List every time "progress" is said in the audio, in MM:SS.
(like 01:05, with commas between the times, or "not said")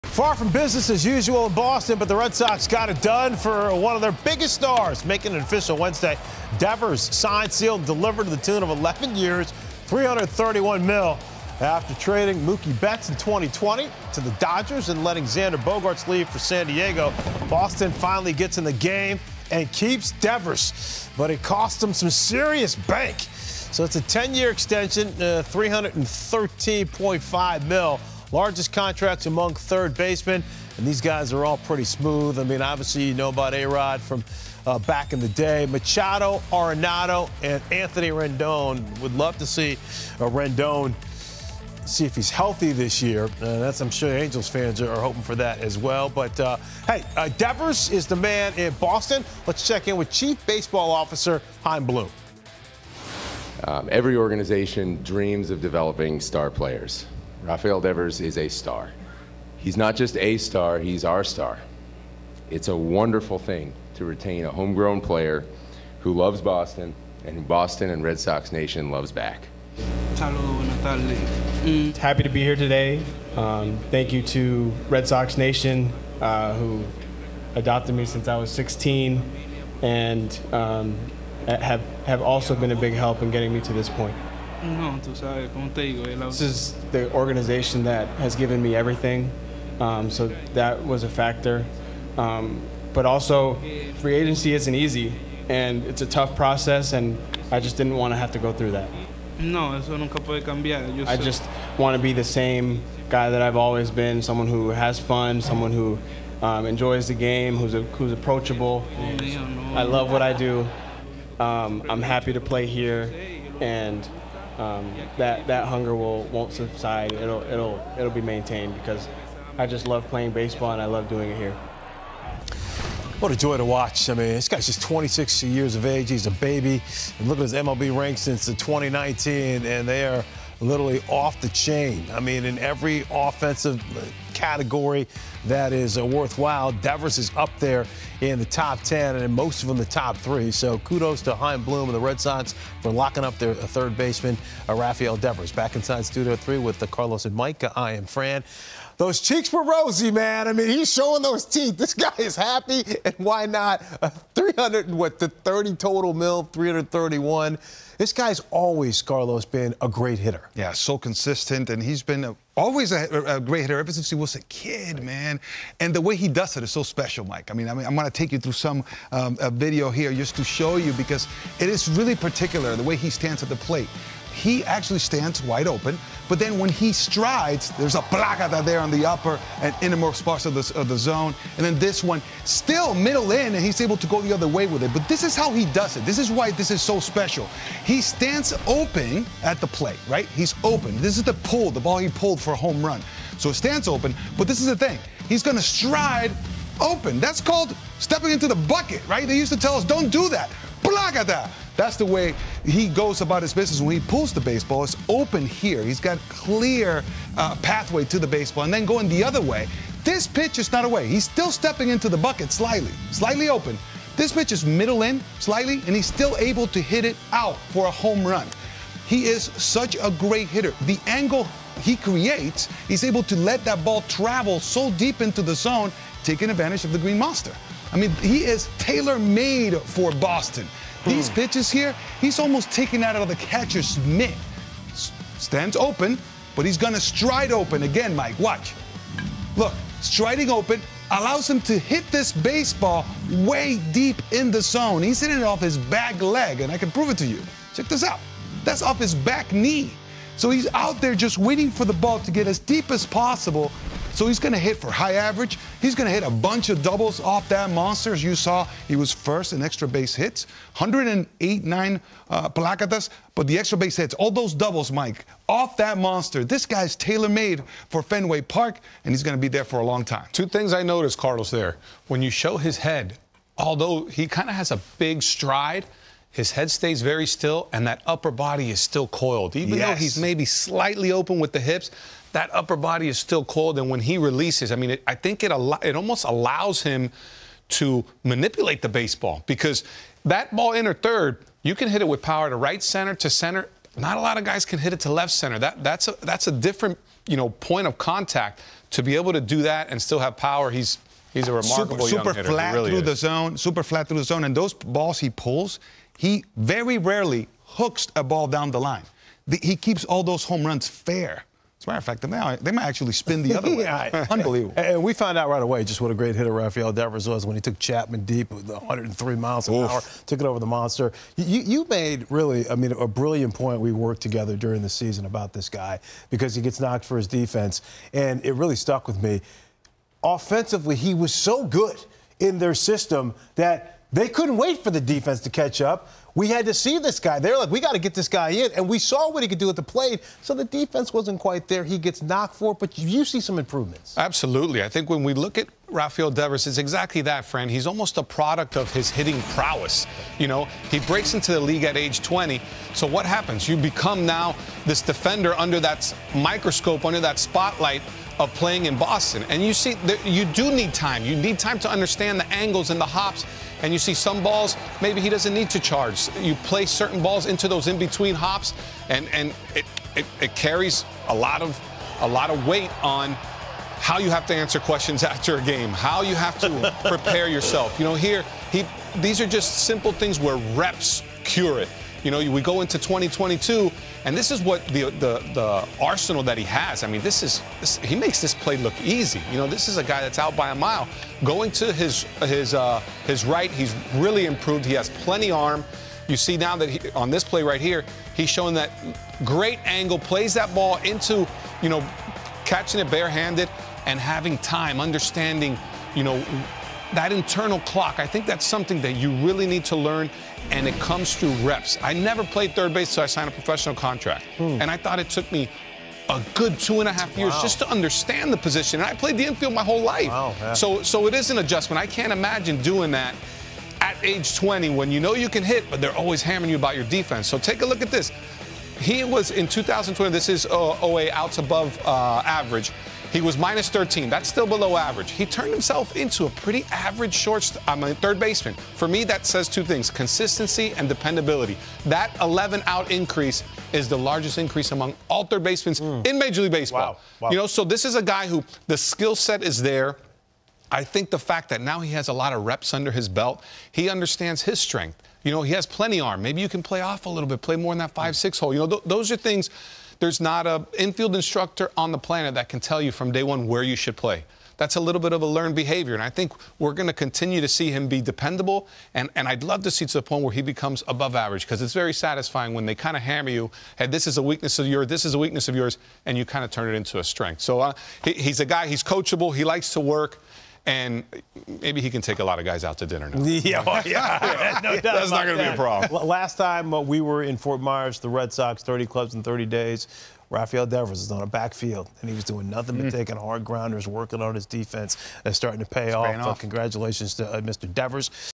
not said.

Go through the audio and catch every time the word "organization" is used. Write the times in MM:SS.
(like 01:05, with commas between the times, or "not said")
00:54, 01:27.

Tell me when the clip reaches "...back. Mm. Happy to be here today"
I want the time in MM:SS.
01:09.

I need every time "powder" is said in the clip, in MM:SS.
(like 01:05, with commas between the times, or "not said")
not said.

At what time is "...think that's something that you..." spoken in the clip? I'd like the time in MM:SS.
06:48.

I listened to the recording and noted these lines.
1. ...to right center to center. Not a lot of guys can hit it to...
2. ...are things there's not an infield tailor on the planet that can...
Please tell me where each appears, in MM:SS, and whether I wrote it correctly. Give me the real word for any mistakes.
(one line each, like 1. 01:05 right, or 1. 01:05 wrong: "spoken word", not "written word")
1. 04:52 right
2. 07:39 wrong: "instructor", not "tailor".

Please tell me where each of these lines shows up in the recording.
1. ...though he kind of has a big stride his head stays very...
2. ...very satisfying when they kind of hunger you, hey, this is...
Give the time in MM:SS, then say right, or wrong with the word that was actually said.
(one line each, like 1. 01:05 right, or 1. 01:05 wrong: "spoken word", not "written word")
1. 04:33 wrong: "although", not "though"
2. 07:51 wrong: "hammer", not "hunger".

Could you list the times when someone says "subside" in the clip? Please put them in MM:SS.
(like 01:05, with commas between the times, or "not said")
01:56.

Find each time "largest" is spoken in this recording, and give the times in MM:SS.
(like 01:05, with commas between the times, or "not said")
00:28, 07:24.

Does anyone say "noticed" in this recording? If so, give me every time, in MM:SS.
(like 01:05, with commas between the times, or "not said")
04:30.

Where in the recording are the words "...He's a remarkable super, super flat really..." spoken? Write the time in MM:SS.
05:01.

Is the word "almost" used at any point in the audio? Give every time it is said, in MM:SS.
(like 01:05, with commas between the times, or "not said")
03:52, 04:45, 05:47.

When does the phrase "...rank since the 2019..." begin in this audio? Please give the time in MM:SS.
02:07.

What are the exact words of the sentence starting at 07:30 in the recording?
I think the fact that now he has a lot of reps under his belt, he understands his strength.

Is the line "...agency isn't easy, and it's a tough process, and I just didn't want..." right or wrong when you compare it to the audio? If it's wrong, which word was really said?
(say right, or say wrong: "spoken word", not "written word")
right.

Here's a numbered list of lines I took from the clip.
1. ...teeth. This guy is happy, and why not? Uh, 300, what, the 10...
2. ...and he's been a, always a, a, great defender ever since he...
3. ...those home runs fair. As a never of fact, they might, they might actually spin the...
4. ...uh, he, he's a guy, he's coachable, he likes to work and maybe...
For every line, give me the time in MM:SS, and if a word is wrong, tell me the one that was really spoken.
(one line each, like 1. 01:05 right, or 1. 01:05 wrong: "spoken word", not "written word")
1. 02:31 wrong: "30", not "10"
2. 02:41 wrong: "hitter", not "defender"
3. 05:10 wrong: "matter", not "never"
4. 07:57 right.